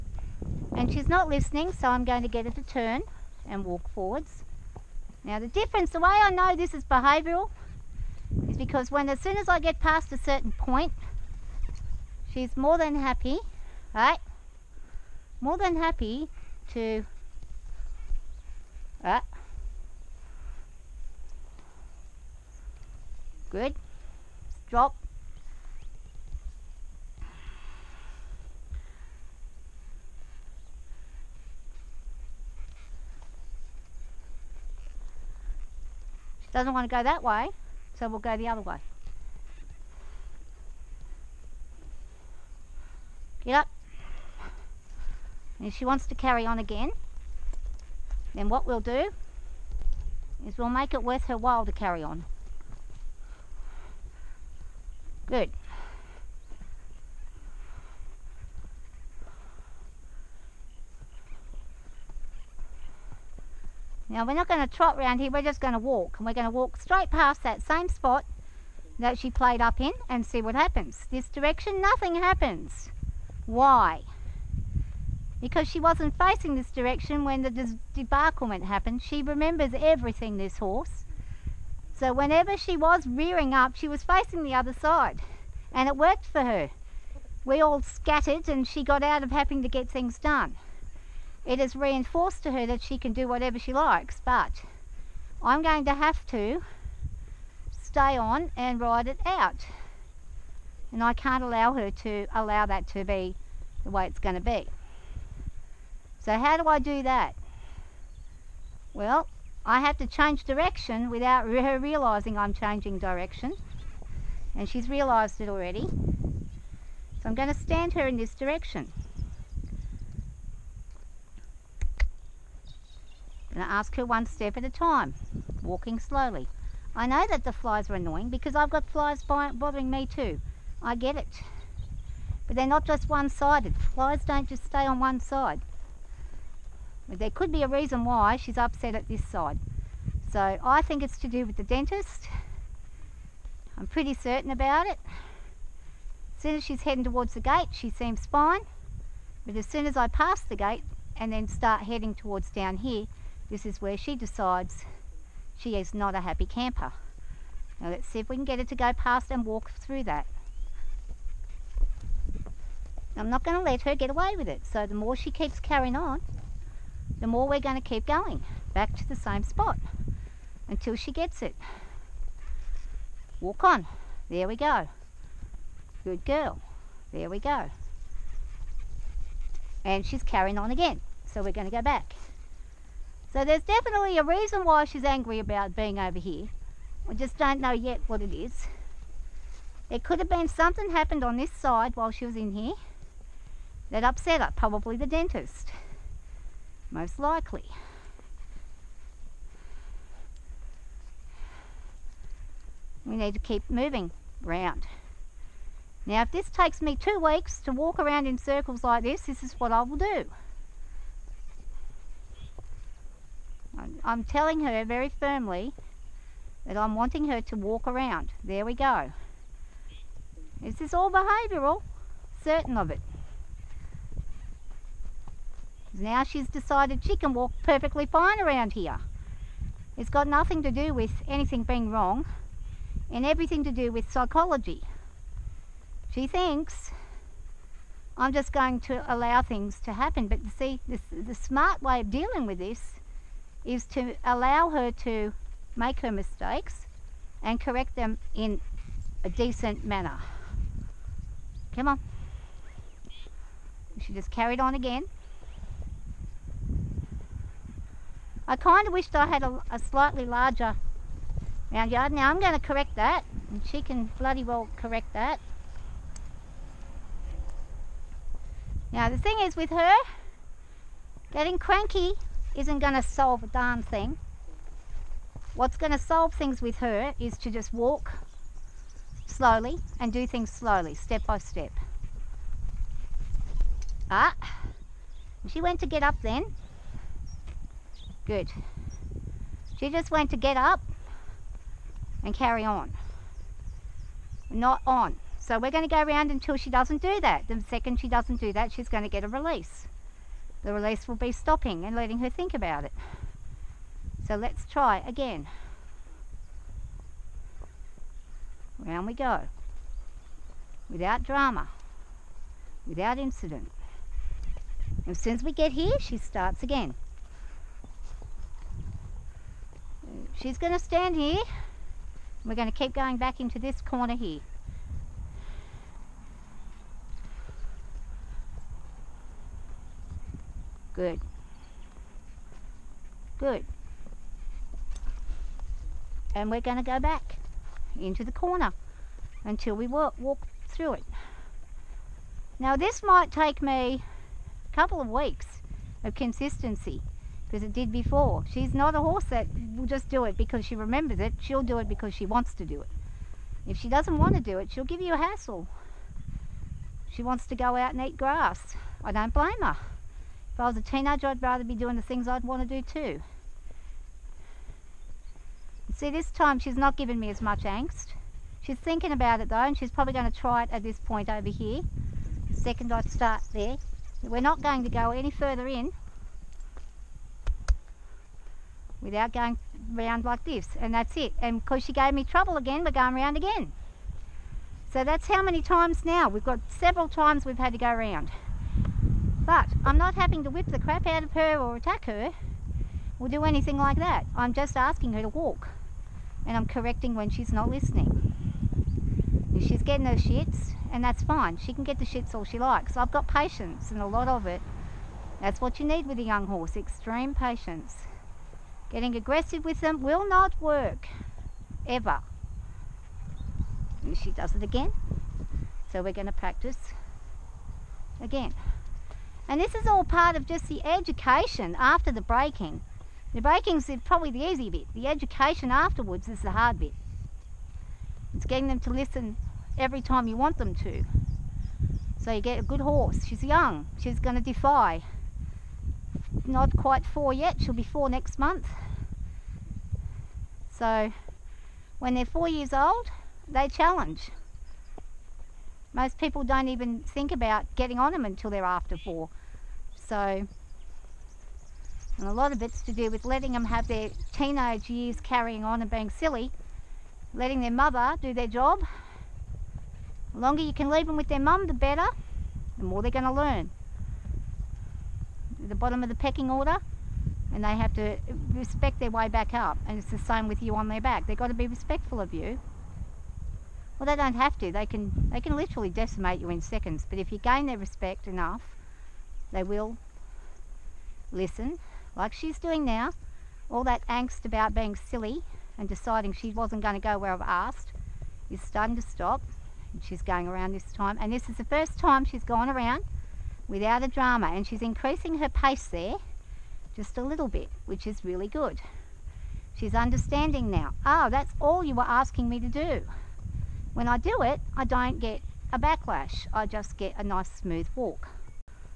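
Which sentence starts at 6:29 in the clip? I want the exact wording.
But I'm not having to whip the crap out of her or attack her or do anything like that.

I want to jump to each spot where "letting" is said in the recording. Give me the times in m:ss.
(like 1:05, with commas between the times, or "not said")
5:01, 7:33, 7:37.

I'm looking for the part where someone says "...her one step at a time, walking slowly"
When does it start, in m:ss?
2:03.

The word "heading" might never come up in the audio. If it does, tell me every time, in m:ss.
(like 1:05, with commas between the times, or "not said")
2:26, 2:31.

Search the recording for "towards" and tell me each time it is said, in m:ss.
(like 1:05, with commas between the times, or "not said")
2:27, 2:32.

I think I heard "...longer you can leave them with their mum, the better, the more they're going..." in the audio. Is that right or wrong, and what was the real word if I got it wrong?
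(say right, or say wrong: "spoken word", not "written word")
right.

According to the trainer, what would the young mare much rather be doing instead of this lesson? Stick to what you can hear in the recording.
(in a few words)
eat grass.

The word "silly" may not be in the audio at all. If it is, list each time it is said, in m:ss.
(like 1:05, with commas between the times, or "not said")
7:36, 8:04.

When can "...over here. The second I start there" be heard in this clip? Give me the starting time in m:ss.
6:11.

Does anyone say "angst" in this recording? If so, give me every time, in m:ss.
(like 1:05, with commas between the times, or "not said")
6:07, 8:04.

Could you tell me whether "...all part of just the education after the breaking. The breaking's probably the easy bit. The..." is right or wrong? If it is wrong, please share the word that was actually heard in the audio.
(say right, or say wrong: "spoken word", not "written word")
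right.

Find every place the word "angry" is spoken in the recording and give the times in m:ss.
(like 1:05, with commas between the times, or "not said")
3:05.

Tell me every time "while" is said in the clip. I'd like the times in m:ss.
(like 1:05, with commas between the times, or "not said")
0:51, 3:11.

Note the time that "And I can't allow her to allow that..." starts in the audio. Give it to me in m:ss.
1:40.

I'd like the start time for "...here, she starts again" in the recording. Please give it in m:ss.
5:15.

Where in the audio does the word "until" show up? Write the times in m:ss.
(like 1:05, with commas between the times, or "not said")
2:50, 4:56, 5:39, 7:28.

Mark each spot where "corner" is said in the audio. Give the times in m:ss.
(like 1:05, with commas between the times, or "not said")
5:23, 5:38.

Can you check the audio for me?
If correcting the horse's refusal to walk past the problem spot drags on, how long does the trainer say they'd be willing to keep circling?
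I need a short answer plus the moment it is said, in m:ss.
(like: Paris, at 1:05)
two weeks, at 3:26.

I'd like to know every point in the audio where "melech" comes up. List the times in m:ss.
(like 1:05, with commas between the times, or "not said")
not said.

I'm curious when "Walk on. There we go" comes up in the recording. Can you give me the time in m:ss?
2:53.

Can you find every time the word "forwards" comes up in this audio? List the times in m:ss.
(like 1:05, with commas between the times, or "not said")
0:03.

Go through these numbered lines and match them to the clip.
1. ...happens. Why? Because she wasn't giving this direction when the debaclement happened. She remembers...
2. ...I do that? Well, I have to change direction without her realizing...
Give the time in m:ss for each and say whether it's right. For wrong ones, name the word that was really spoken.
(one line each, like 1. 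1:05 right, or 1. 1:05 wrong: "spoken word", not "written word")
1. 1:12 wrong: "facing", not "giving"
2. 1:46 right.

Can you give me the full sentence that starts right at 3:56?
She thinks I'm just going to allow things to happen.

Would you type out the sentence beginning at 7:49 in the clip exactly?
And it's the same with you on their back.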